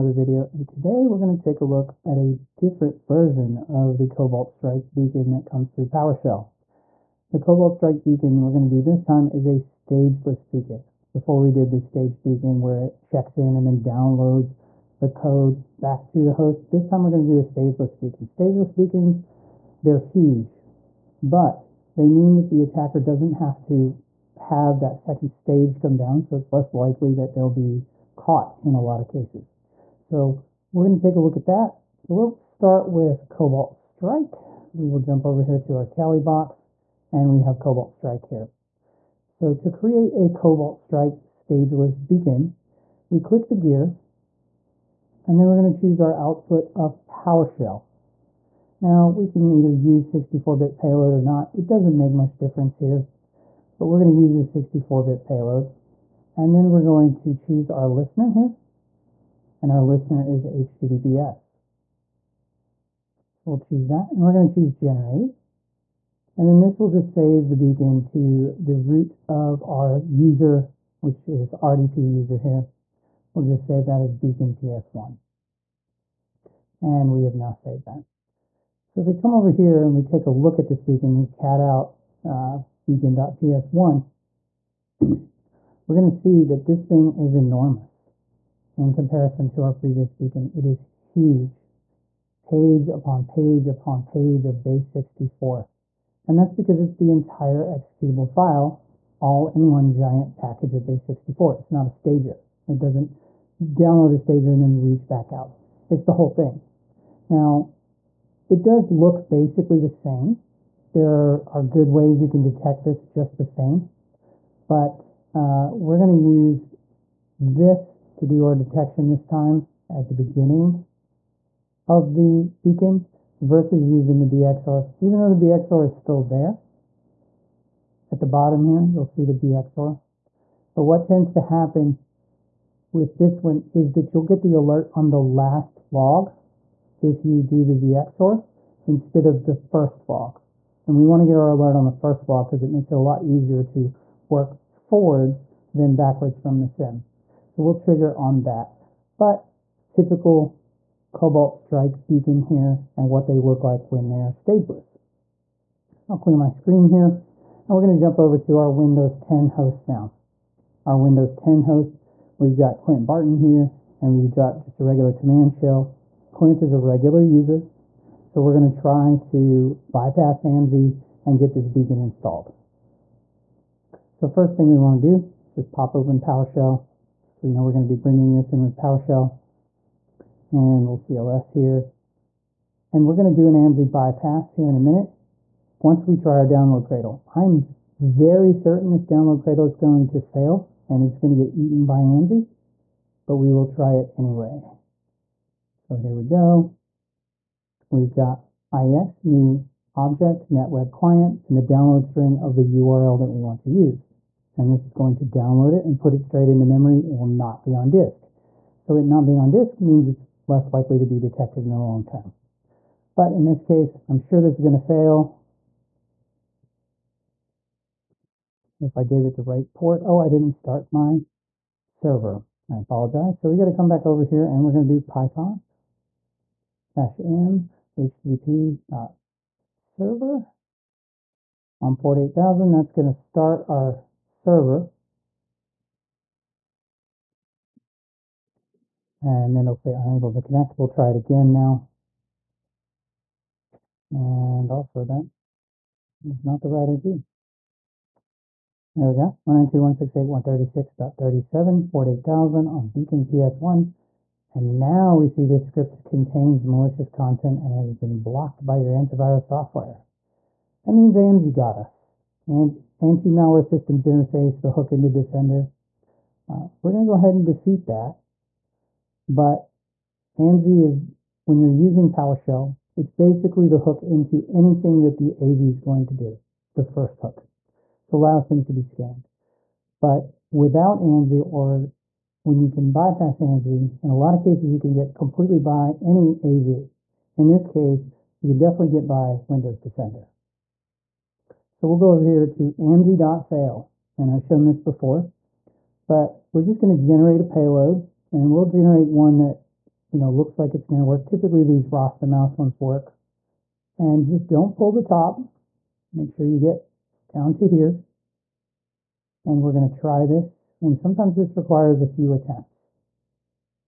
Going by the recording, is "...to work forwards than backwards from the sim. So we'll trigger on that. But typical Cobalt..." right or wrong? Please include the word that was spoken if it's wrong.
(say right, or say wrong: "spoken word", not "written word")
right.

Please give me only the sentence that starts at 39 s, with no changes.
So to create a Cobalt Strike stageless beacon, we click the gear, and then we're going to choose our output of PowerShell.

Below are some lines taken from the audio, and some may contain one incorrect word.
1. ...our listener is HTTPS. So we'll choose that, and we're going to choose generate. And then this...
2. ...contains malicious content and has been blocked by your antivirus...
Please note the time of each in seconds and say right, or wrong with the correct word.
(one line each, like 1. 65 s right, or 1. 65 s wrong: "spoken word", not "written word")
1. 59 s right
2. 256 s right.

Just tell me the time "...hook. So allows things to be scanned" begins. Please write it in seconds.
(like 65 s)
277 s.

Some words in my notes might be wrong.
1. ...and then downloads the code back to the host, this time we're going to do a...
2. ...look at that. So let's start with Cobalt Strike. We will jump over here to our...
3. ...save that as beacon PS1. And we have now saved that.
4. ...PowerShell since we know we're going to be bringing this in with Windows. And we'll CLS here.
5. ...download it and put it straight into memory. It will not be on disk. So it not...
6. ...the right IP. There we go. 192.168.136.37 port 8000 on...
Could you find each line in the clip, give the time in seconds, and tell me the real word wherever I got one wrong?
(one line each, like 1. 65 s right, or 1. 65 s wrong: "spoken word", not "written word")
1. 13 s right
2. 31 s right
3. 73 s right
4. 176 s wrong: "PowerShell", not "Windows"
5. 205 s right
6. 246 s right.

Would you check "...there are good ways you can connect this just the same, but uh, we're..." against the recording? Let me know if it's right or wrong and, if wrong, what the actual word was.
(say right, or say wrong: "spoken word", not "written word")
wrong: "detect", not "connect".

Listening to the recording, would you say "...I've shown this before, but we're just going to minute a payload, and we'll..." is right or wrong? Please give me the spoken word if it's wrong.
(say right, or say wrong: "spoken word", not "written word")
wrong: "generate", not "minute".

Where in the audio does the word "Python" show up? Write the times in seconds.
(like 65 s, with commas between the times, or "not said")
225 s.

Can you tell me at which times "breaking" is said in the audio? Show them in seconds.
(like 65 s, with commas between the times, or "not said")
not said.